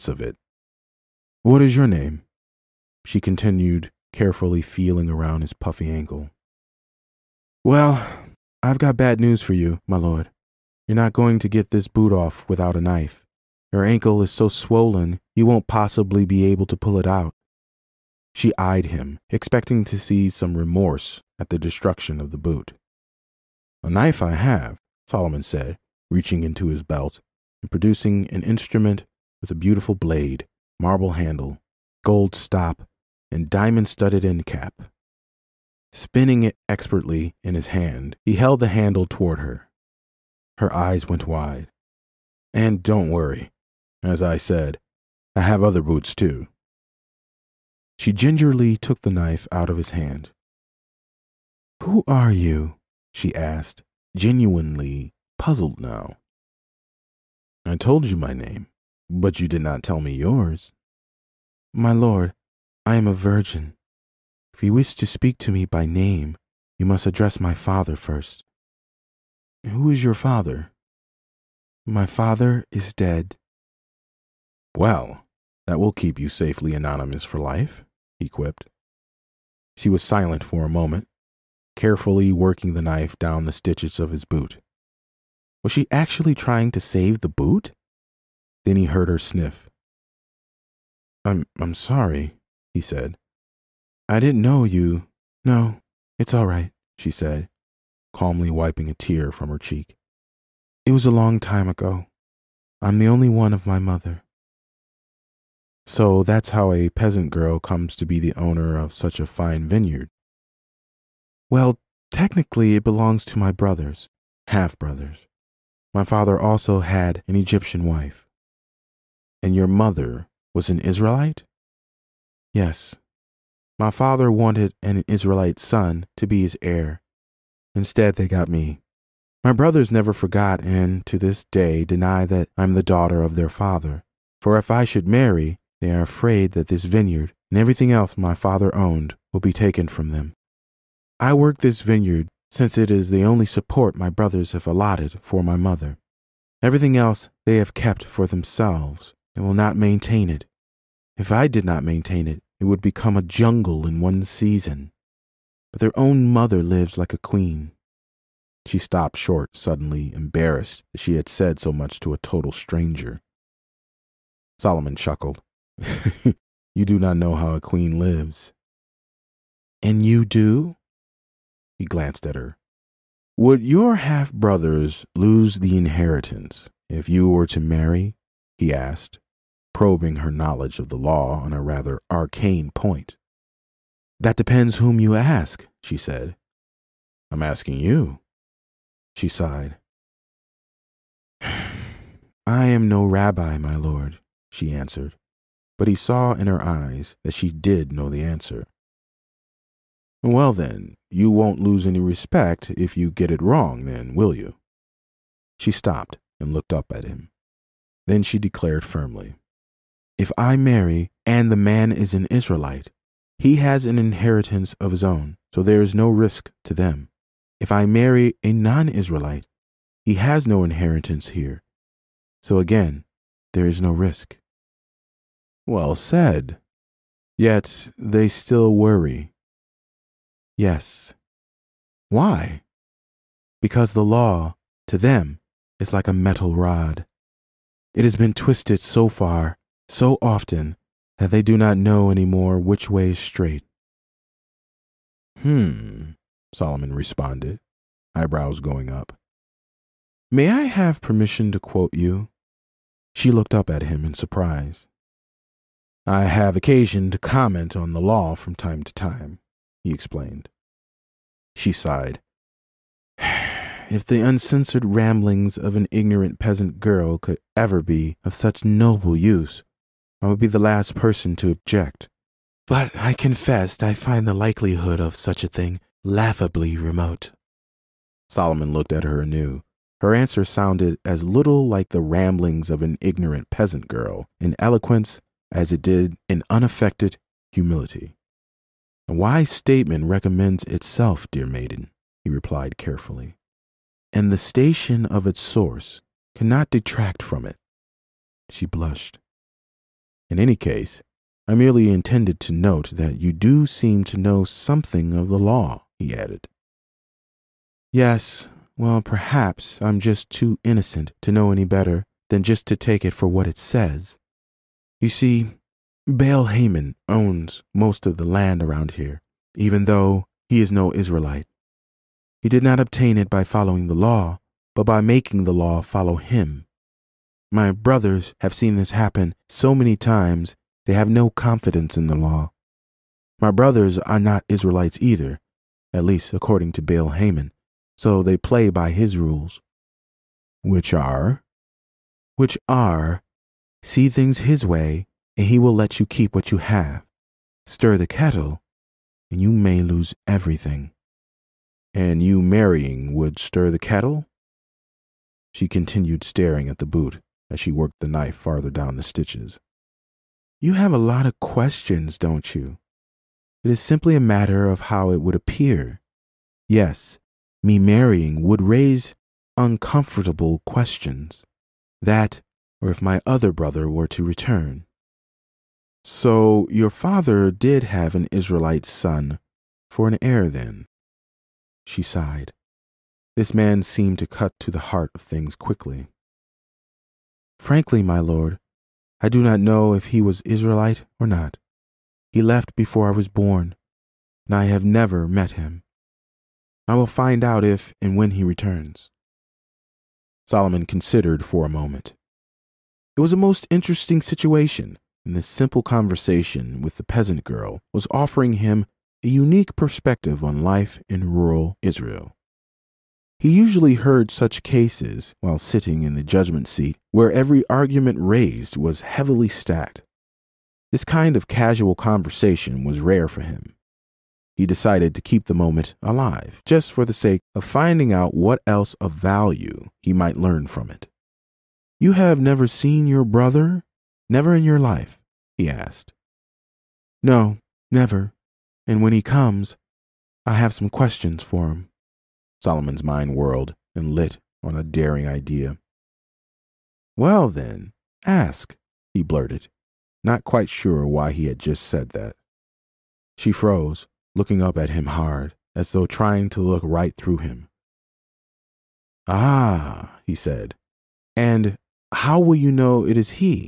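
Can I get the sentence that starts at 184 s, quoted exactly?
That depends whom you ask, she said.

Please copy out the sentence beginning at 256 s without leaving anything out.
I have occasion to comment on the law from time to time, he explained.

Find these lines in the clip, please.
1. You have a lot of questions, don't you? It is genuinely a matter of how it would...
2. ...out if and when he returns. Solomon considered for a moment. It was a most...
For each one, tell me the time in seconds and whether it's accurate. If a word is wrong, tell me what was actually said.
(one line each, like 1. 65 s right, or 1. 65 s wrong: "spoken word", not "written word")
1. 360 s wrong: "simply", not "genuinely"
2. 397 s right.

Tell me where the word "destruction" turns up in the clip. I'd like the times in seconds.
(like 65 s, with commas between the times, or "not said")
21 s.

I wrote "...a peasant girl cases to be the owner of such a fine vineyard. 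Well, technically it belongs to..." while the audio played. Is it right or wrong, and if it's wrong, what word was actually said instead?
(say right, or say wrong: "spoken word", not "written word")
wrong: "comes", not "cases".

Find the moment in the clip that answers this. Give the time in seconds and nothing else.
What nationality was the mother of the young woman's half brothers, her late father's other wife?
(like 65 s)
117 s.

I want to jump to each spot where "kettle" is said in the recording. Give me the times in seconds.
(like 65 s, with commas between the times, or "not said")
348 s, 353 s.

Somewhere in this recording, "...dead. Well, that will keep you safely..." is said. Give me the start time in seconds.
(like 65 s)
72 s.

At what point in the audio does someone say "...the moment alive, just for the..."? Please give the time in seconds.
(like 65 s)
425 s.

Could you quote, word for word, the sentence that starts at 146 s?
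Everything else they have kept for themselves and will not maintain it.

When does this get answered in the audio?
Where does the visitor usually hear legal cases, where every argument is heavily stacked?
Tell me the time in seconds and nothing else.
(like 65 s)
416 s.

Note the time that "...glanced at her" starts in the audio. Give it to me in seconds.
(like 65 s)
171 s.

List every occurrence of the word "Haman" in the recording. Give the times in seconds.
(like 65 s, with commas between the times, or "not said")
316 s, 337 s.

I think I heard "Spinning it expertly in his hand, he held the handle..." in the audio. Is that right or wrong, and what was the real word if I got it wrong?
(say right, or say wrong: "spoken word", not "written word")
right.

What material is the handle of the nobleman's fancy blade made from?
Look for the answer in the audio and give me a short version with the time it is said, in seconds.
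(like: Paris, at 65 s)
Marble, at 30 s.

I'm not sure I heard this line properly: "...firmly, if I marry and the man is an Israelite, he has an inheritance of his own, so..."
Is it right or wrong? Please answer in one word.
right.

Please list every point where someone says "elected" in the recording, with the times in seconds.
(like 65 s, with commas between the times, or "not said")
not said.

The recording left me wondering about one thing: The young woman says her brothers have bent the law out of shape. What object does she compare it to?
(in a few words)
A metal rod.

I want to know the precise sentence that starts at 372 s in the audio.
That, or if my other brother were to return.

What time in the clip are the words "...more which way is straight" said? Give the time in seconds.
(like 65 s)
242 s.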